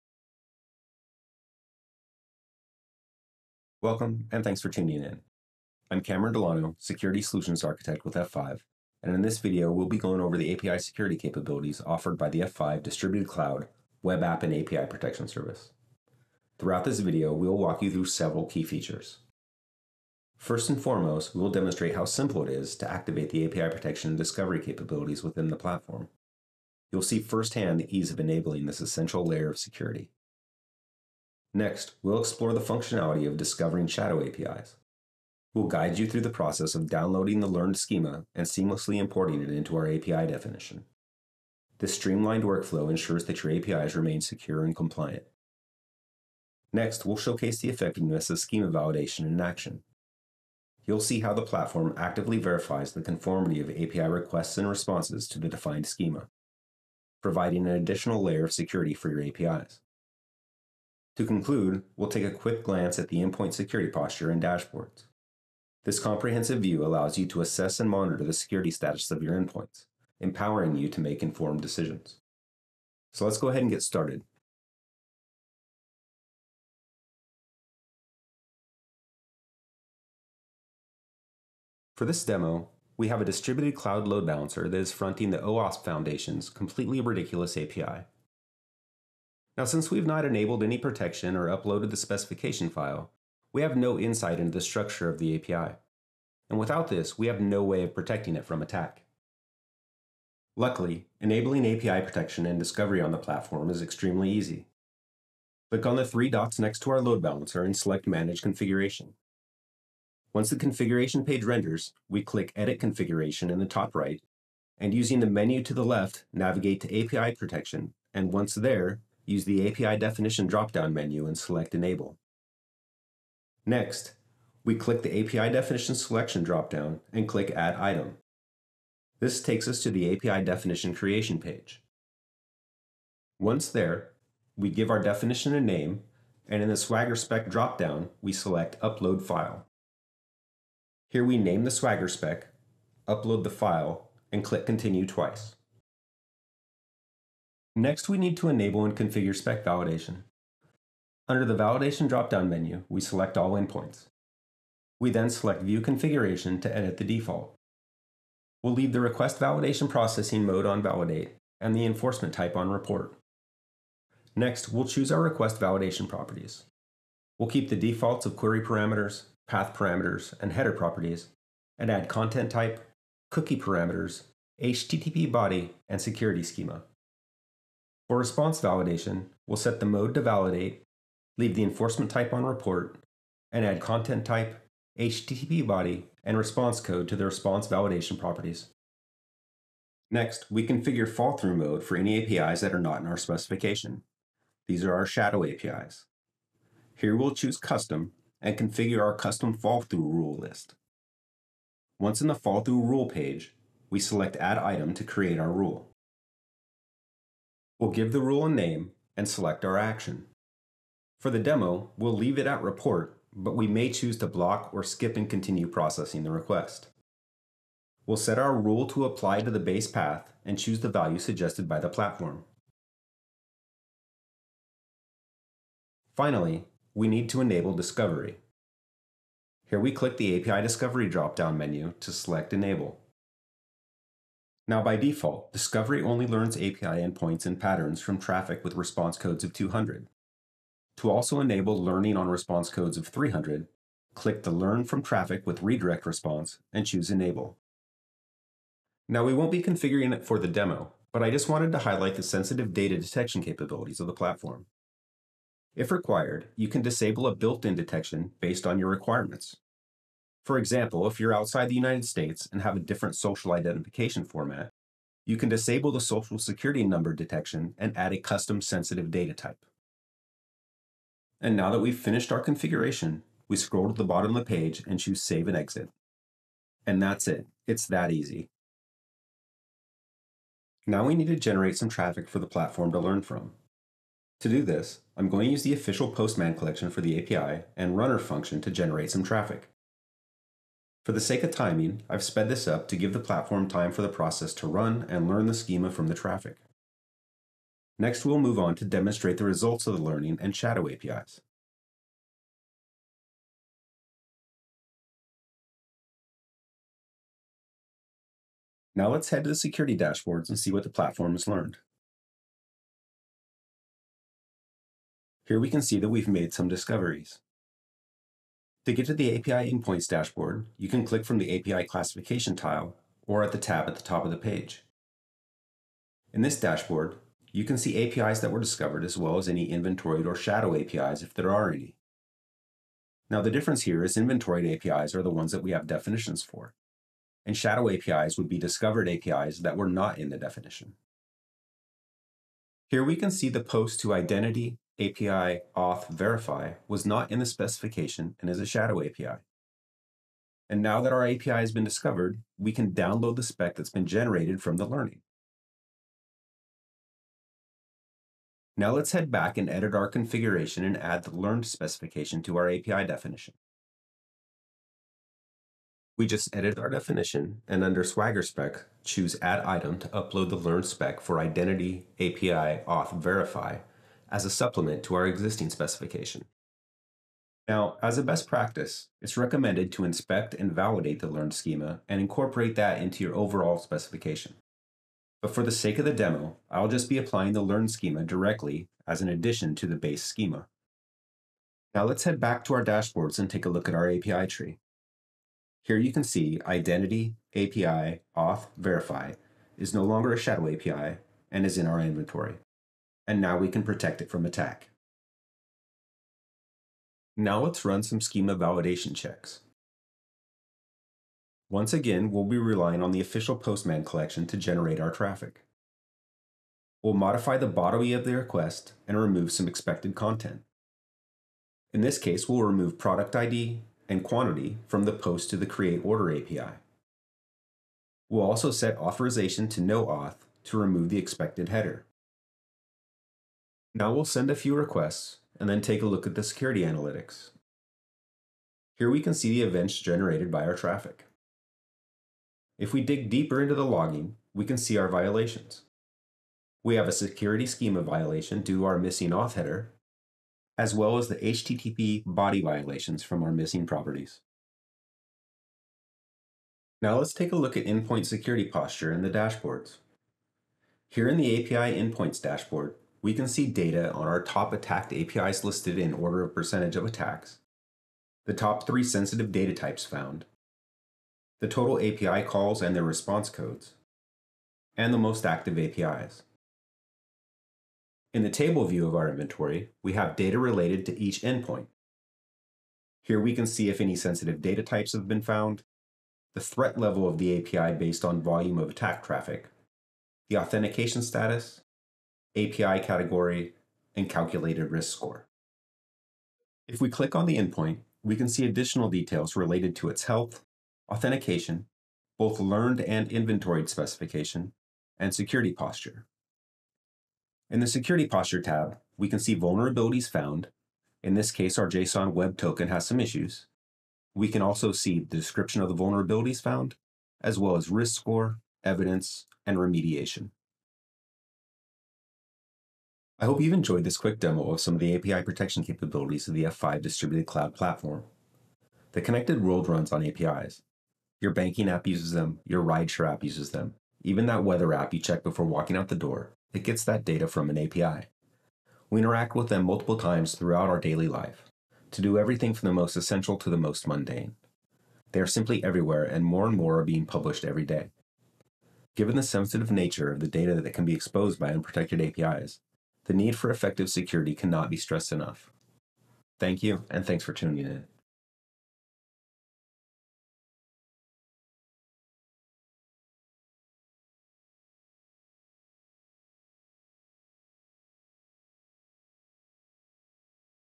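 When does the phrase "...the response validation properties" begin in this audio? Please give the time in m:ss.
3:07.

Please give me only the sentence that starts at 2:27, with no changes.
Next, we need to enable and configure spec validation.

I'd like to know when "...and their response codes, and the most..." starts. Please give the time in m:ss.
7:52.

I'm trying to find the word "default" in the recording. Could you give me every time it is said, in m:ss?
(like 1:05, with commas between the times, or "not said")
2:37, 2:47, 3:54.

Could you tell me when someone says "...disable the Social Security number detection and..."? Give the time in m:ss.
4:25.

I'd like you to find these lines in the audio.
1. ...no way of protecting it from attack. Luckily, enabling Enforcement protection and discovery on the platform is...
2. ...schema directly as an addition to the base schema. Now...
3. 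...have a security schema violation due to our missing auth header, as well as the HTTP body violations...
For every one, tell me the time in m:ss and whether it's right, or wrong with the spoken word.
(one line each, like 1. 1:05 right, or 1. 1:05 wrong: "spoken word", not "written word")
1. 1:37 wrong: "API", not "Enforcement"
2. 6:27 right
3. 7:26 right.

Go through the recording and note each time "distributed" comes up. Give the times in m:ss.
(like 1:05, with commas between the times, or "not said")
0:12, 1:23, 8:47.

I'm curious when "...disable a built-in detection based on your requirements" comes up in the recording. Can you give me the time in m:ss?
4:16.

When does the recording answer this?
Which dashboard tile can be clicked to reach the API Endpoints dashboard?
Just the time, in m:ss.
5:21.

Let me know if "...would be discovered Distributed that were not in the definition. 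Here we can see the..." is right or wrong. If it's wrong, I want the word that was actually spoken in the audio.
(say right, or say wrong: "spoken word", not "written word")
wrong: "APIs", not "Distributed".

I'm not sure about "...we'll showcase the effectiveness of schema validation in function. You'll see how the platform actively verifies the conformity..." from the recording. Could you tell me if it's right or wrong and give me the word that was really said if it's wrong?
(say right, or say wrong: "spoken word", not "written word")
wrong: "action", not "function".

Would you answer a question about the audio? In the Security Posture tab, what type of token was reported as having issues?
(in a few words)
JSON web token.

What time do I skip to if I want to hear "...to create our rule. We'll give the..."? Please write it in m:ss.
3:24.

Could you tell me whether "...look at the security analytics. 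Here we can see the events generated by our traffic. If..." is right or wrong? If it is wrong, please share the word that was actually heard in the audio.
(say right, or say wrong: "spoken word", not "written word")
right.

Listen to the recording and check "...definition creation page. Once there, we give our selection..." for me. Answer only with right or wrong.
wrong.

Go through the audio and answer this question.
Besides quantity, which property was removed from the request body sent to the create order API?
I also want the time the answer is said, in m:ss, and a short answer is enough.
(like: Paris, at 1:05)
product ID, at 7:02.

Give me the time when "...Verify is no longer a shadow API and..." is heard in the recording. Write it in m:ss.
6:38.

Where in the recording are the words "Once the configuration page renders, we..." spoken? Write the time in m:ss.
1:50.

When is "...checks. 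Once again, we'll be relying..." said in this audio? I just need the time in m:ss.
6:49.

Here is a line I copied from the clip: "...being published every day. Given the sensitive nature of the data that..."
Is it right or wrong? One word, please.
right.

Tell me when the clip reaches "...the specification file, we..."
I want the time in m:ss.
1:31.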